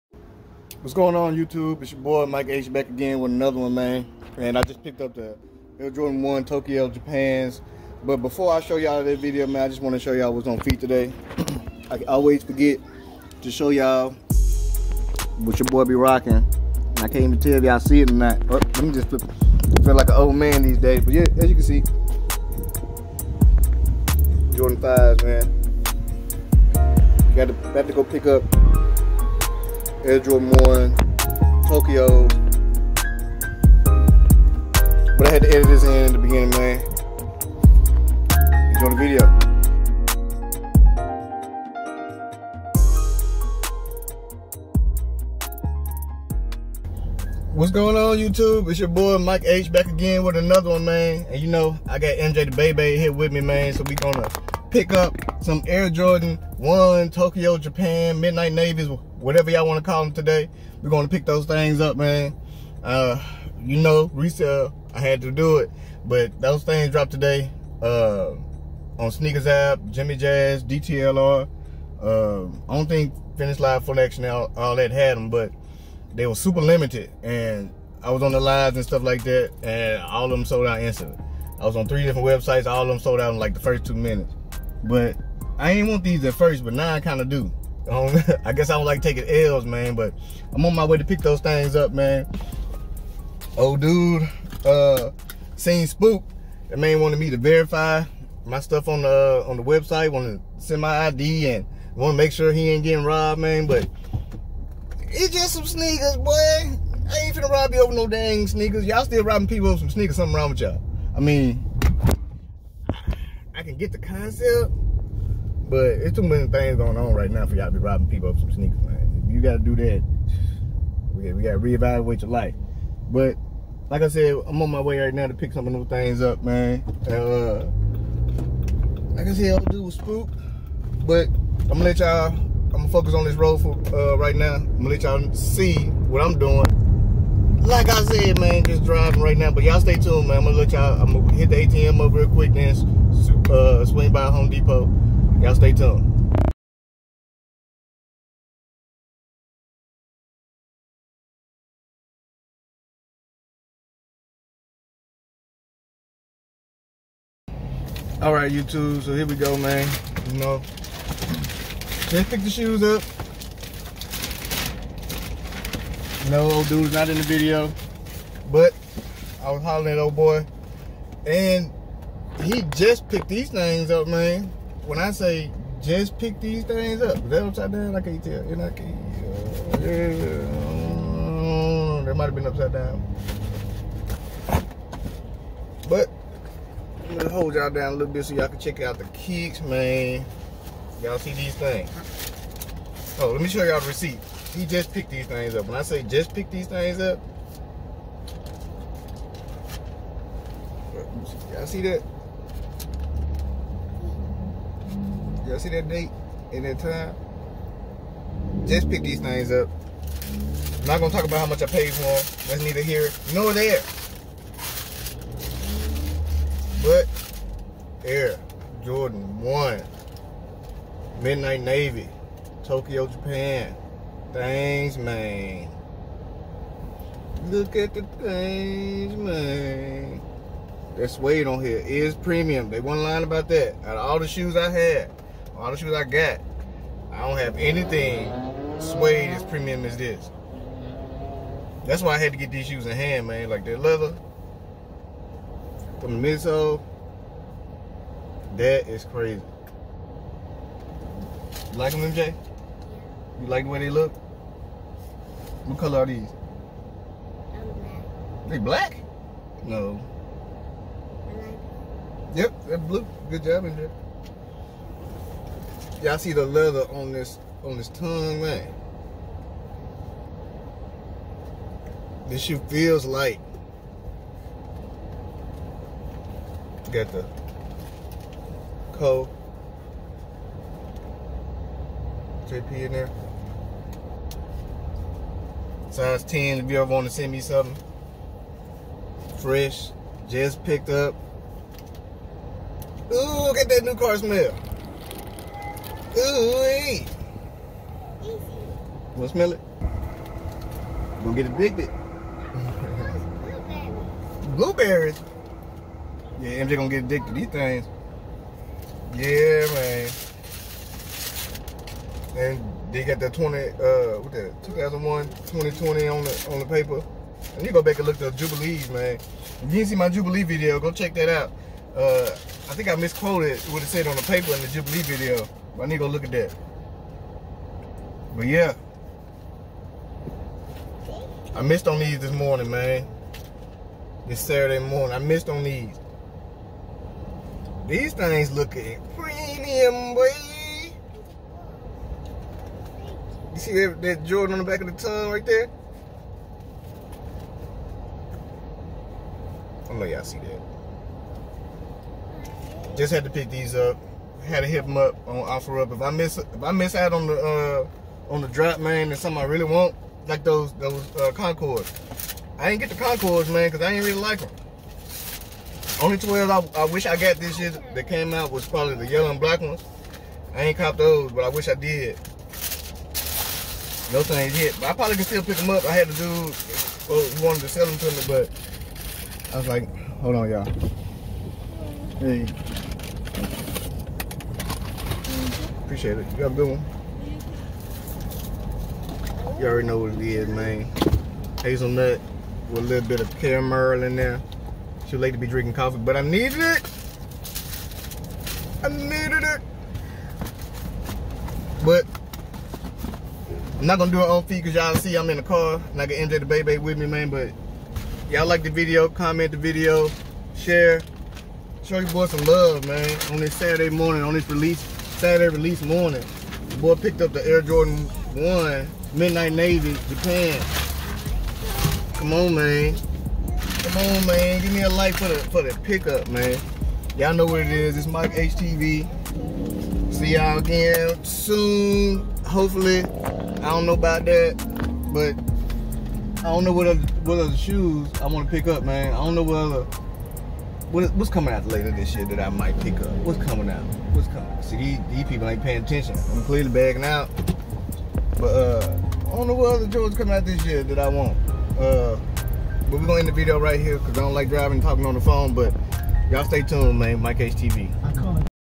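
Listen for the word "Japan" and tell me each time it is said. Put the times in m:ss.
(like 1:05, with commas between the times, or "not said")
0:06, 0:57, 3:43, 7:00.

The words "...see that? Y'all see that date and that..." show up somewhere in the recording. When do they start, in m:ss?
3:21.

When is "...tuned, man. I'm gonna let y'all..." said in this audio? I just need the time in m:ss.
2:19.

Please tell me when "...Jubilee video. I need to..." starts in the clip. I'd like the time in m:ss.
5:24.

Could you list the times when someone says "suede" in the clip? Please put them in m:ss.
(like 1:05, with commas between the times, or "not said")
3:51, 3:58.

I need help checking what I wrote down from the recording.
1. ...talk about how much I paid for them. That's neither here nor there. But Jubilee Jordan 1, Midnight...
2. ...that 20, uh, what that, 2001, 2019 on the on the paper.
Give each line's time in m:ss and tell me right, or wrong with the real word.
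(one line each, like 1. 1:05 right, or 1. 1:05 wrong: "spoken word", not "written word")
1. 3:31 wrong: "Air", not "Jubilee"
2. 5:13 wrong: "2020", not "2019".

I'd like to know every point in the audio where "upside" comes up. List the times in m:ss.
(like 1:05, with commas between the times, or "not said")
2:57, 3:02.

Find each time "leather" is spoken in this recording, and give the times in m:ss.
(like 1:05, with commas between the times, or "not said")
4:03, 4:26.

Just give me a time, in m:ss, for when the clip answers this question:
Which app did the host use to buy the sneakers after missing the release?
5:55.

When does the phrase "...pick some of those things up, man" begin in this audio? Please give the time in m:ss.
2:05.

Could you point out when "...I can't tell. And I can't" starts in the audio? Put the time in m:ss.
2:57.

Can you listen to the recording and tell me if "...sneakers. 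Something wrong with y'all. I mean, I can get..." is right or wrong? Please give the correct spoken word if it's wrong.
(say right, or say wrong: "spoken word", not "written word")
right.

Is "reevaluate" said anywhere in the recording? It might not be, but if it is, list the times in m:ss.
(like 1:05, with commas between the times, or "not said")
2:01.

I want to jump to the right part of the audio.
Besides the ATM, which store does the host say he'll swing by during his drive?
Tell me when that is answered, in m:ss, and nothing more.
2:24.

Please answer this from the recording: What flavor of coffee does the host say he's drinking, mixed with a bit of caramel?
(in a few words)
Hazelnut.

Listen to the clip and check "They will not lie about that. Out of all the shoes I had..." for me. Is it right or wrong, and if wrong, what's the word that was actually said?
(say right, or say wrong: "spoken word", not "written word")
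right.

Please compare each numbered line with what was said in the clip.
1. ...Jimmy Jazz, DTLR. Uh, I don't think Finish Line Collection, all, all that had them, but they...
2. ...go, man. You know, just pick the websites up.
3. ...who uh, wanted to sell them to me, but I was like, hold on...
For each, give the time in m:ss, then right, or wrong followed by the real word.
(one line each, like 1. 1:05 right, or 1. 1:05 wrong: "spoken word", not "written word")
1. 1:09 right
2. 2:39 wrong: "shoes", not "websites"
3. 6:17 right.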